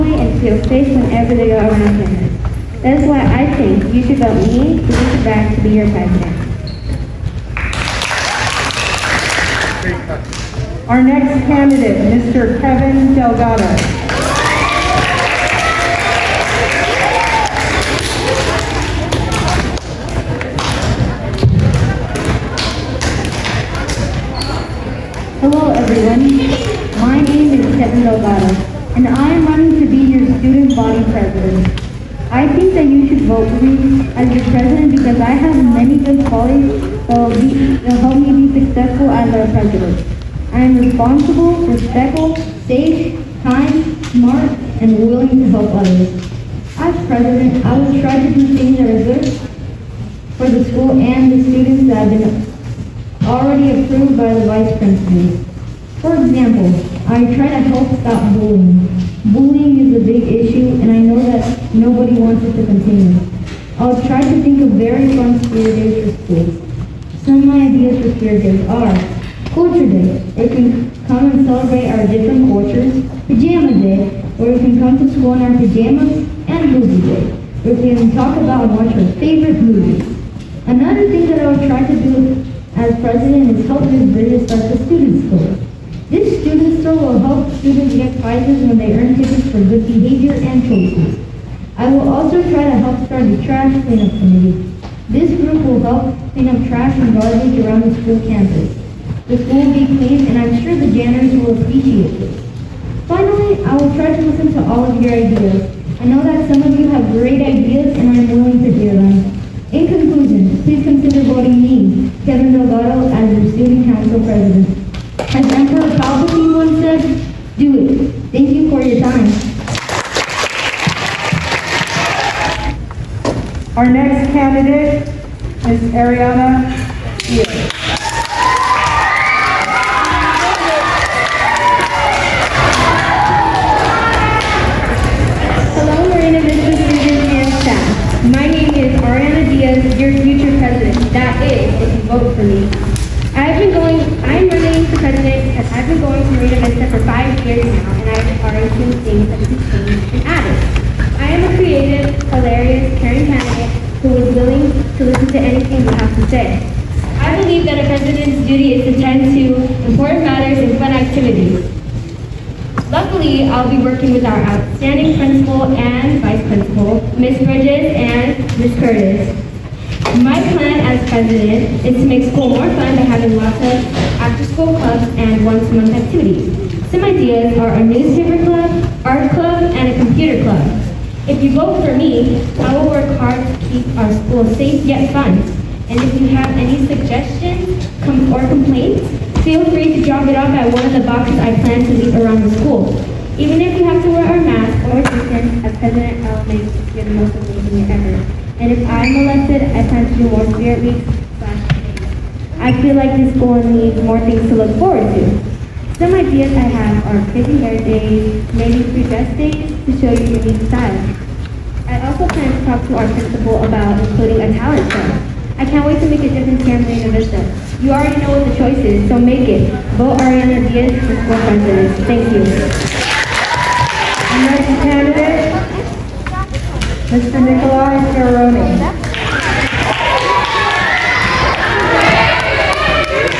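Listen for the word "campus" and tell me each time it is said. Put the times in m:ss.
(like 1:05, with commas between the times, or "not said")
0:02, 1:38.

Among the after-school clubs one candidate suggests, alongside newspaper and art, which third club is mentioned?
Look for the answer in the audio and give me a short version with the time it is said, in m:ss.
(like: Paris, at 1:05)
Computer club, at 2:59.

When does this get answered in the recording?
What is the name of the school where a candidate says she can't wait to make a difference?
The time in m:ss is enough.
3:36.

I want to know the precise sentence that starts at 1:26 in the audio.
This student store will help students get prizes when they earn tickets for good behavior and choices.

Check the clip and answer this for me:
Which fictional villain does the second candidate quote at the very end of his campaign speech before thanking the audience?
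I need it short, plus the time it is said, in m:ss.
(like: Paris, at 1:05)
Emperor Palpatine, at 1:55.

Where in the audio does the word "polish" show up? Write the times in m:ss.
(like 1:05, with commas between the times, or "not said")
not said.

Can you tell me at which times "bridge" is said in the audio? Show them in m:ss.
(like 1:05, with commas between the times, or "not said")
1:24, 2:47.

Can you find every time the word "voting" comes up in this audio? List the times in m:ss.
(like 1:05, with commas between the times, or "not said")
1:51.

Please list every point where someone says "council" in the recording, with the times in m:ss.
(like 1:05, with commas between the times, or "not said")
1:53.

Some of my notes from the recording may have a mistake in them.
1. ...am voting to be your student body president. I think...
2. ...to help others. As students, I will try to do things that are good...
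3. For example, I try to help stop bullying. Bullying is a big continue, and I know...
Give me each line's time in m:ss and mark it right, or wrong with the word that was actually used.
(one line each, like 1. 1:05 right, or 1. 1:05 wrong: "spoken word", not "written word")
1. 0:29 wrong: "running", not "voting"
2. 0:45 wrong: "president", not "students"
3. 0:56 wrong: "issue", not "continue".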